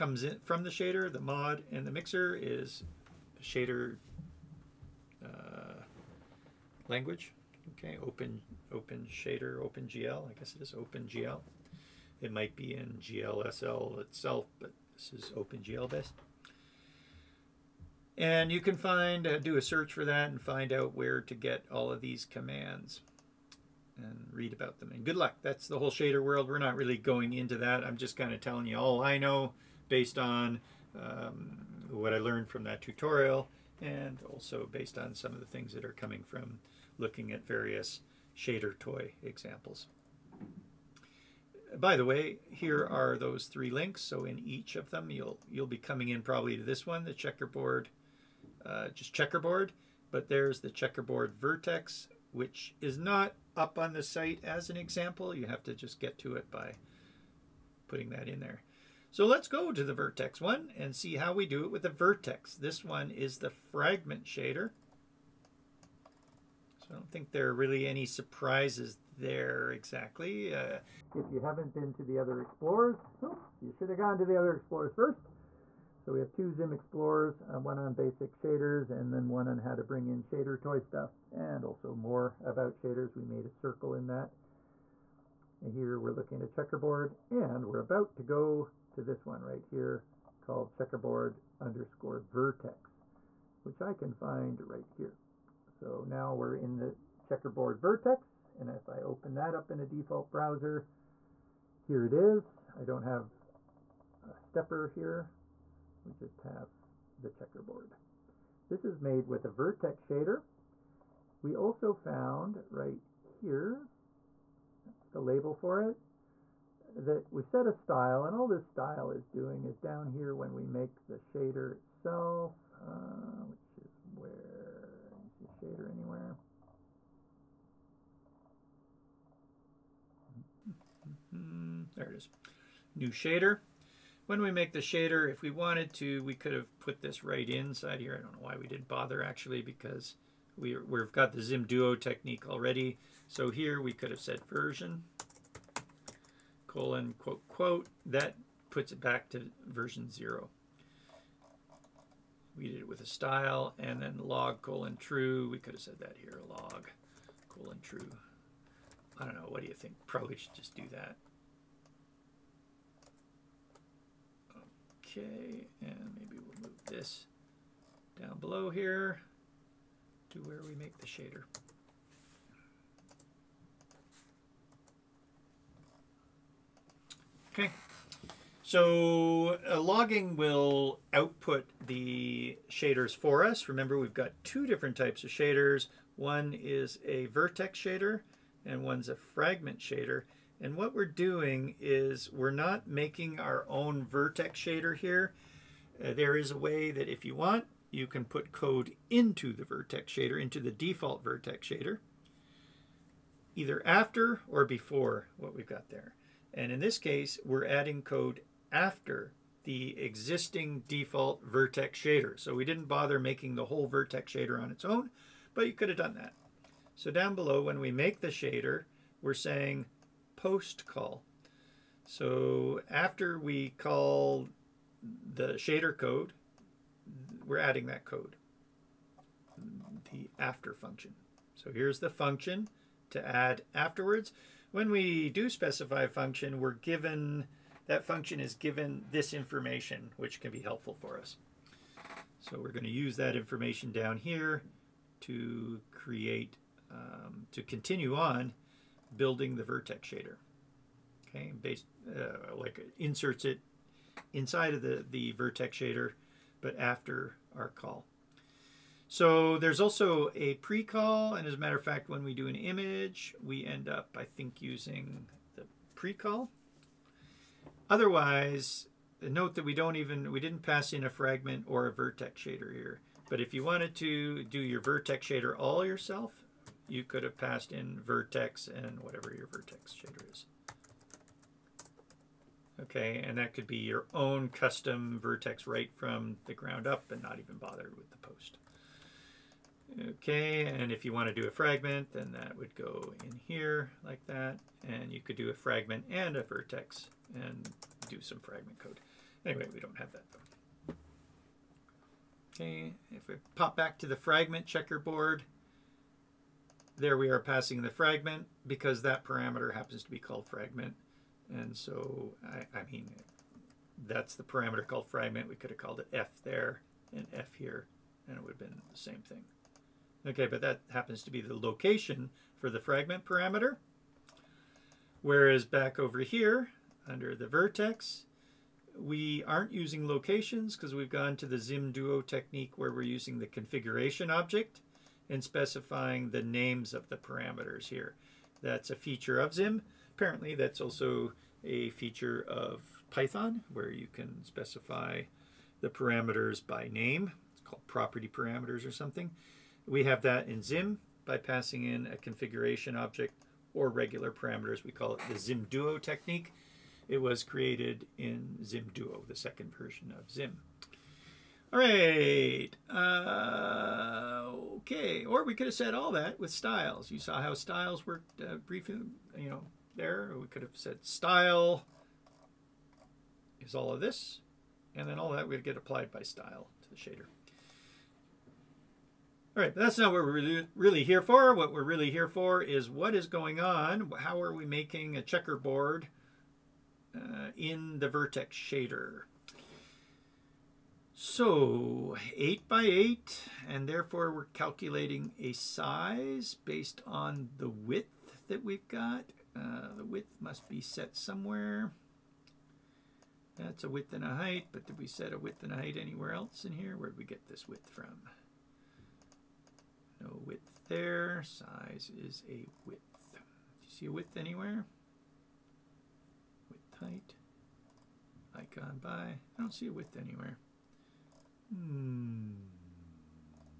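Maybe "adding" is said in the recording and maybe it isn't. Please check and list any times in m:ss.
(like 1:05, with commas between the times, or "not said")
3:27, 3:47.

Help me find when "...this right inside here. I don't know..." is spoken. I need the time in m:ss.
2:17.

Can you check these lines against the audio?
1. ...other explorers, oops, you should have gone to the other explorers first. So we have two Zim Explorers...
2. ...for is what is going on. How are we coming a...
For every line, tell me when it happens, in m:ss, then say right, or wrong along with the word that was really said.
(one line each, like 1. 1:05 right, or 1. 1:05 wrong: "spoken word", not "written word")
1. 1:12 right
2. 6:22 wrong: "making", not "coming".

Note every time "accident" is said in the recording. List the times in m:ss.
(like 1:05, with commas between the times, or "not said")
not said.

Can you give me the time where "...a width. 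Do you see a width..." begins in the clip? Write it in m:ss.
6:52.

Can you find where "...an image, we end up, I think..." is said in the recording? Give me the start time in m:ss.
4:22.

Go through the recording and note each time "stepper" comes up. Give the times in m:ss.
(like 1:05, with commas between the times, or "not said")
1:44.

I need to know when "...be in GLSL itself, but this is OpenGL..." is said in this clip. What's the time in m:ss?
0:12.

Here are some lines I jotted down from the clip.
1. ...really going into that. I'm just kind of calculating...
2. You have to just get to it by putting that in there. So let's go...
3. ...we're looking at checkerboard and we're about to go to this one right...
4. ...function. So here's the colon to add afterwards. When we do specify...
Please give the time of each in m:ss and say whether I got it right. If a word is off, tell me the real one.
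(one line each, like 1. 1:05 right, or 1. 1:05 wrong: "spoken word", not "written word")
1. 0:26 wrong: "telling", not "calculating"
2. 0:55 right
3. 1:25 right
4. 3:50 wrong: "function", not "colon".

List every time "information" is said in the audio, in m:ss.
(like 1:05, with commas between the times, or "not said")
3:59, 4:03.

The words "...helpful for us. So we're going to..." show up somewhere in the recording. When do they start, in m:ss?
4:00.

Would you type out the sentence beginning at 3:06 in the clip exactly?
One is a vertex shader and one's a fragment shader.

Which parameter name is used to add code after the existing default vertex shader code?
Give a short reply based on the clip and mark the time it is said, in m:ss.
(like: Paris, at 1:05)
post call, at 3:40.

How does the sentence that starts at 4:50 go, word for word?
Okay, and if you want to do a fragment, then that would go in here like that.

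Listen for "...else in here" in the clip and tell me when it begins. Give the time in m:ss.
6:46.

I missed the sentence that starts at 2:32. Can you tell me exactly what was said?
We did it with a style, and then log, colon, true.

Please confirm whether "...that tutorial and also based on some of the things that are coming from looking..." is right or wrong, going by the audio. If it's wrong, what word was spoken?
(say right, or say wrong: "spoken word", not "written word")
right.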